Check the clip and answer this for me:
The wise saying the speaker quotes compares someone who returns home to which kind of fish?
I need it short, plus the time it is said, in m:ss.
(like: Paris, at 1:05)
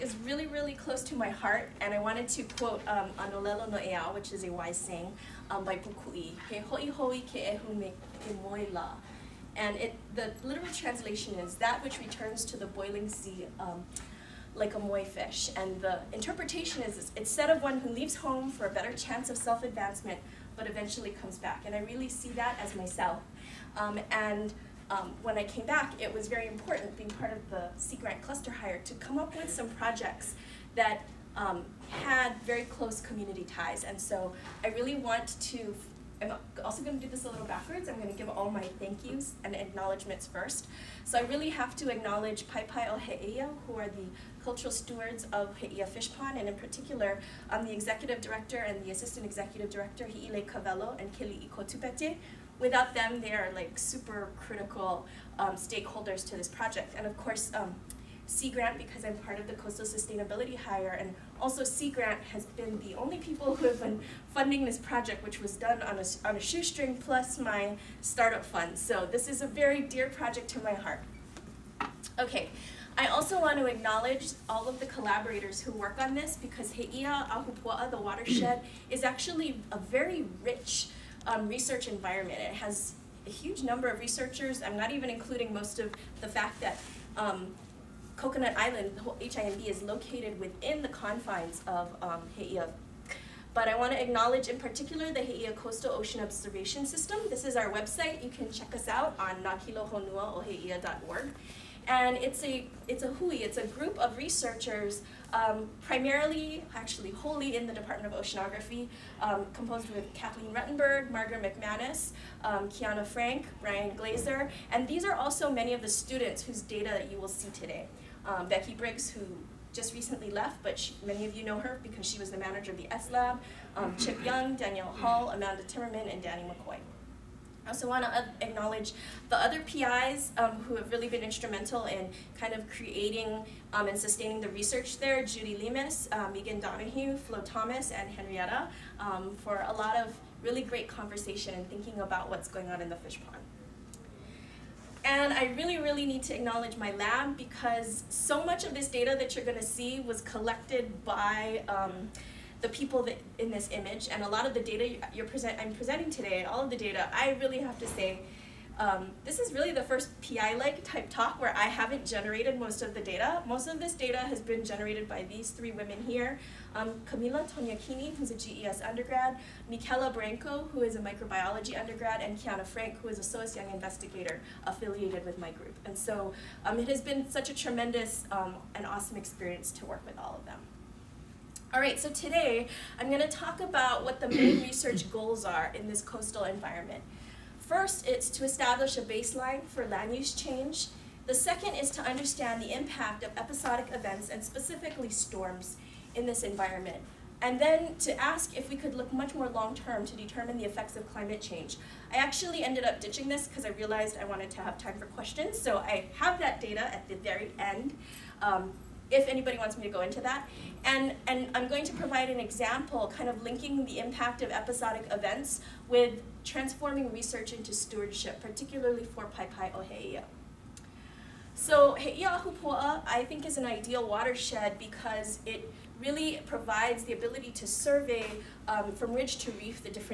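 moi, at 0:14.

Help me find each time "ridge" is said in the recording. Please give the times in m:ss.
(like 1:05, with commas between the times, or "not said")
3:49.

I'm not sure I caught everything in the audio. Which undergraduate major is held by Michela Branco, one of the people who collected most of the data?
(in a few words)
microbiology.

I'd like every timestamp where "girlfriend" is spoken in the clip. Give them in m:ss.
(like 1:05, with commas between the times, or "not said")
not said.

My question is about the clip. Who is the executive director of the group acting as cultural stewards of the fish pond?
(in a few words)
Hi'ilei Kawelo.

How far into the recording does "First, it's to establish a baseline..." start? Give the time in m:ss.
3:07.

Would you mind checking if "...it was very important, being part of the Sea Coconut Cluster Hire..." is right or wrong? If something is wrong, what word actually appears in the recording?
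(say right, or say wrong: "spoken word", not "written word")
wrong: "Grant", not "Coconut".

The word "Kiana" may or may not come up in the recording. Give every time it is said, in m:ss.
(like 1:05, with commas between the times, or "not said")
1:52, 2:52.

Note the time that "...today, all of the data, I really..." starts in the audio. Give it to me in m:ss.
2:36.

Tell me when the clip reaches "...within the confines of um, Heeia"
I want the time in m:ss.
1:30.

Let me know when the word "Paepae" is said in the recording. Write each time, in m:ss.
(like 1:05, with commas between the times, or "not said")
0:42.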